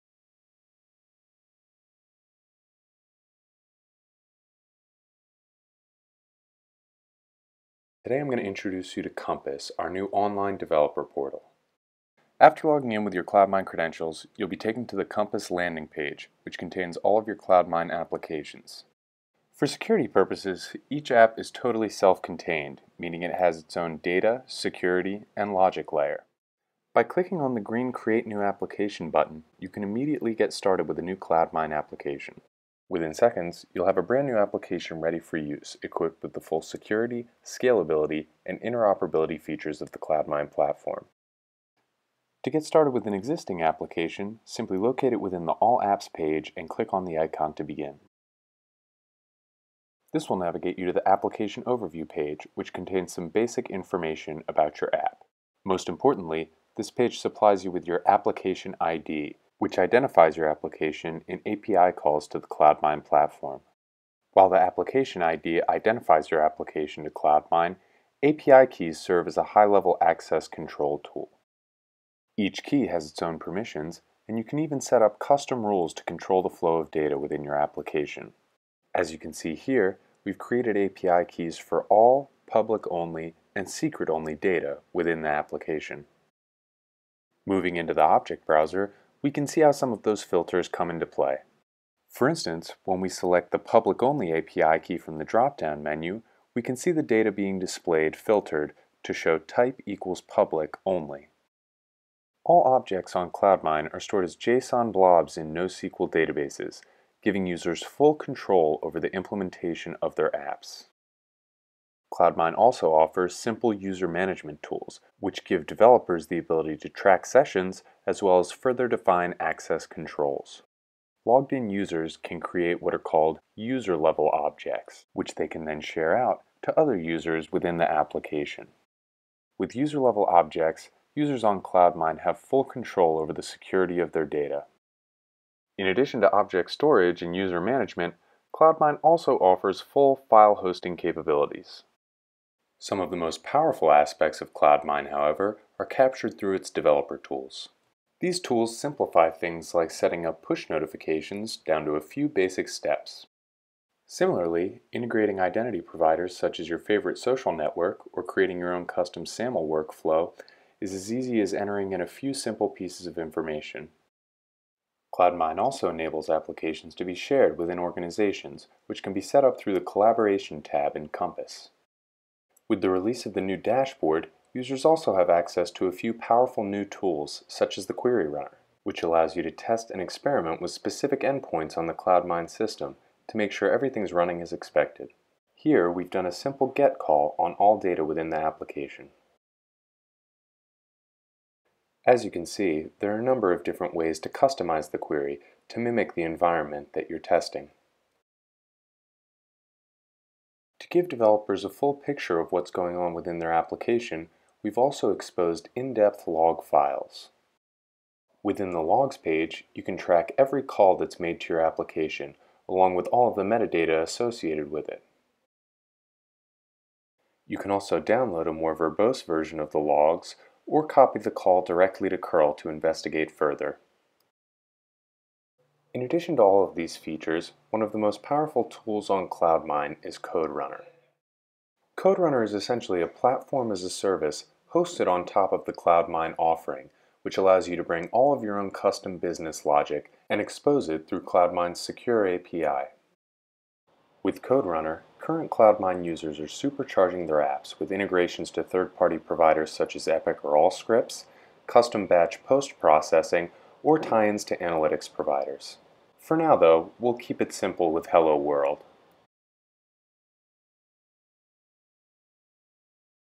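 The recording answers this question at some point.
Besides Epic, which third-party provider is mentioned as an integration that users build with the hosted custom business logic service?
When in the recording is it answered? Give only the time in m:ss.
4:10.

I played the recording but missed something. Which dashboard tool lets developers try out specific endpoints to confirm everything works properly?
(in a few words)
Query Runner.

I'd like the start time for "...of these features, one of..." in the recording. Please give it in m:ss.
3:46.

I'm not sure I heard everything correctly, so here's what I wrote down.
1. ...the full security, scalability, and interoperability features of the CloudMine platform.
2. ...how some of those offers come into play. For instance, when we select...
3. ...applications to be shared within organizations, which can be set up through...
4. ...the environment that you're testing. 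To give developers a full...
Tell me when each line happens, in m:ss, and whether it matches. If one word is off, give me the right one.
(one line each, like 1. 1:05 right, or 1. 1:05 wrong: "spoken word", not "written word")
1. 0:36 right
2. 1:29 wrong: "filters", not "offers"
3. 2:46 right
4. 3:16 right.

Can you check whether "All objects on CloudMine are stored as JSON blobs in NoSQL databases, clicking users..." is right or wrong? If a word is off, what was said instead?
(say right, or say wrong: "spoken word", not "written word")
wrong: "giving", not "clicking".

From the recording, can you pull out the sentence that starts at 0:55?
Most importantly, this page supplies you with your application ID, which identifies your application in API calls to the CloudMine platform.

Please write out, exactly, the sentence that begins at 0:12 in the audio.
After logging in with your CloudMine credentials, you'll be taken to the Compass landing page, which contains all of your CloudMine applications.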